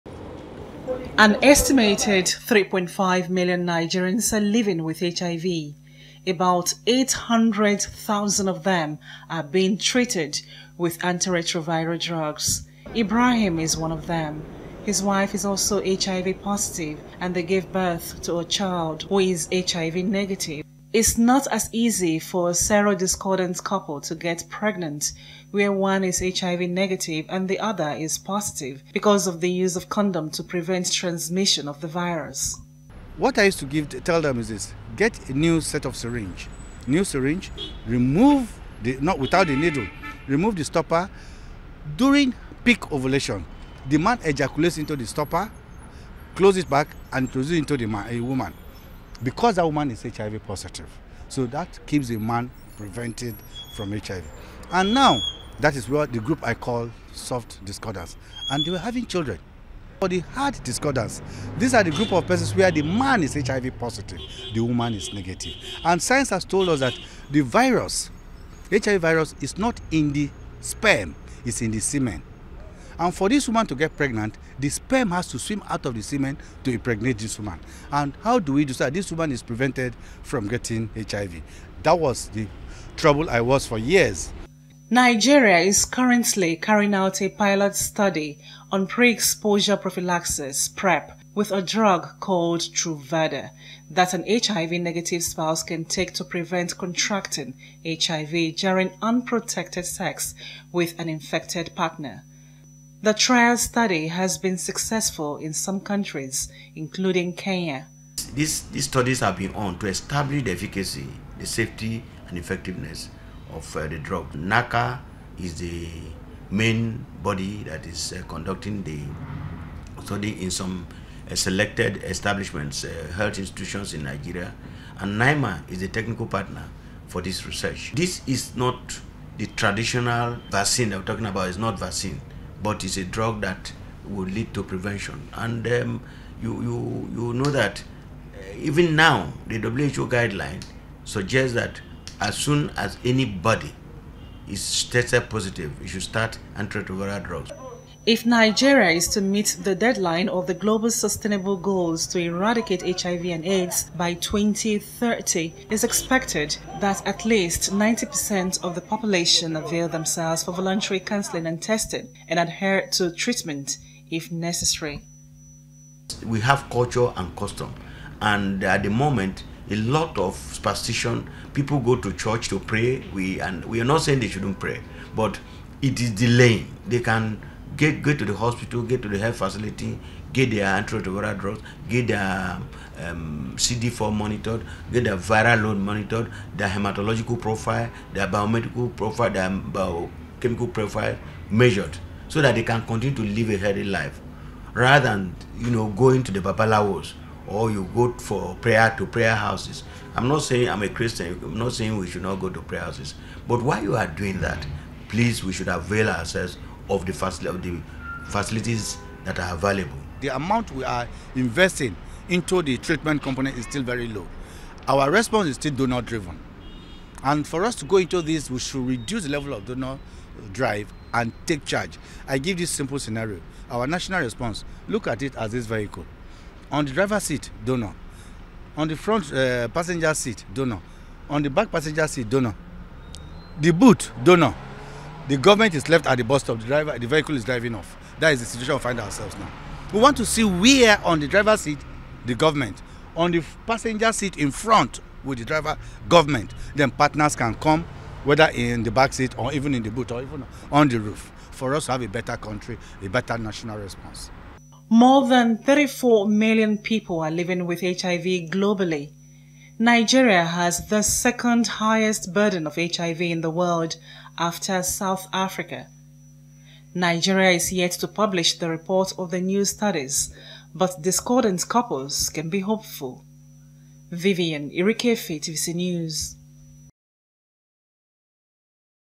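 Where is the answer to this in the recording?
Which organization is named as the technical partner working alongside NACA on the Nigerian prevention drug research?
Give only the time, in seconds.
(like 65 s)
125 s.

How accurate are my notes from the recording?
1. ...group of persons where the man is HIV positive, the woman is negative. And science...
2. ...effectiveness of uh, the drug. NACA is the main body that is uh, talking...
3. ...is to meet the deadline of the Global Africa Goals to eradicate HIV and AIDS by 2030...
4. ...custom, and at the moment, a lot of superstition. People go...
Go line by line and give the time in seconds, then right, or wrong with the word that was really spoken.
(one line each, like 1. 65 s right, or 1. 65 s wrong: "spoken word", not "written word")
1. 61 s right
2. 112 s wrong: "conducting", not "talking"
3. 148 s wrong: "Sustainable", not "Africa"
4. 167 s right.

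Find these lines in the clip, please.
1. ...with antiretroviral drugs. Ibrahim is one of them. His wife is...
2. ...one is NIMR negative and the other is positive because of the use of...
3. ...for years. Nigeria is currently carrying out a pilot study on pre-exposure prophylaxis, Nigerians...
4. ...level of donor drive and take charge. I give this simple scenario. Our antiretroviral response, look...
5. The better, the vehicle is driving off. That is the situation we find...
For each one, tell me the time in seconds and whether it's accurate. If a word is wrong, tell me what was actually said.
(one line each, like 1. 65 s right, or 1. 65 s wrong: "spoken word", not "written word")
1. 10 s right
2. 25 s wrong: "HIV", not "NIMR"
3. 83 s wrong: "PrEP", not "Nigerians"
4. 219 s wrong: "national", not "antiretroviral"
5. 236 s wrong: "driver", not "better".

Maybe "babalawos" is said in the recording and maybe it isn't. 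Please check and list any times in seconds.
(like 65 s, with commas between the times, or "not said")
196 s.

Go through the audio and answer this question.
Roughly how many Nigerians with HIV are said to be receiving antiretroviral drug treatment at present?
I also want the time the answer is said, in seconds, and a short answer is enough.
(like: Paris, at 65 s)
800,000, at 6 s.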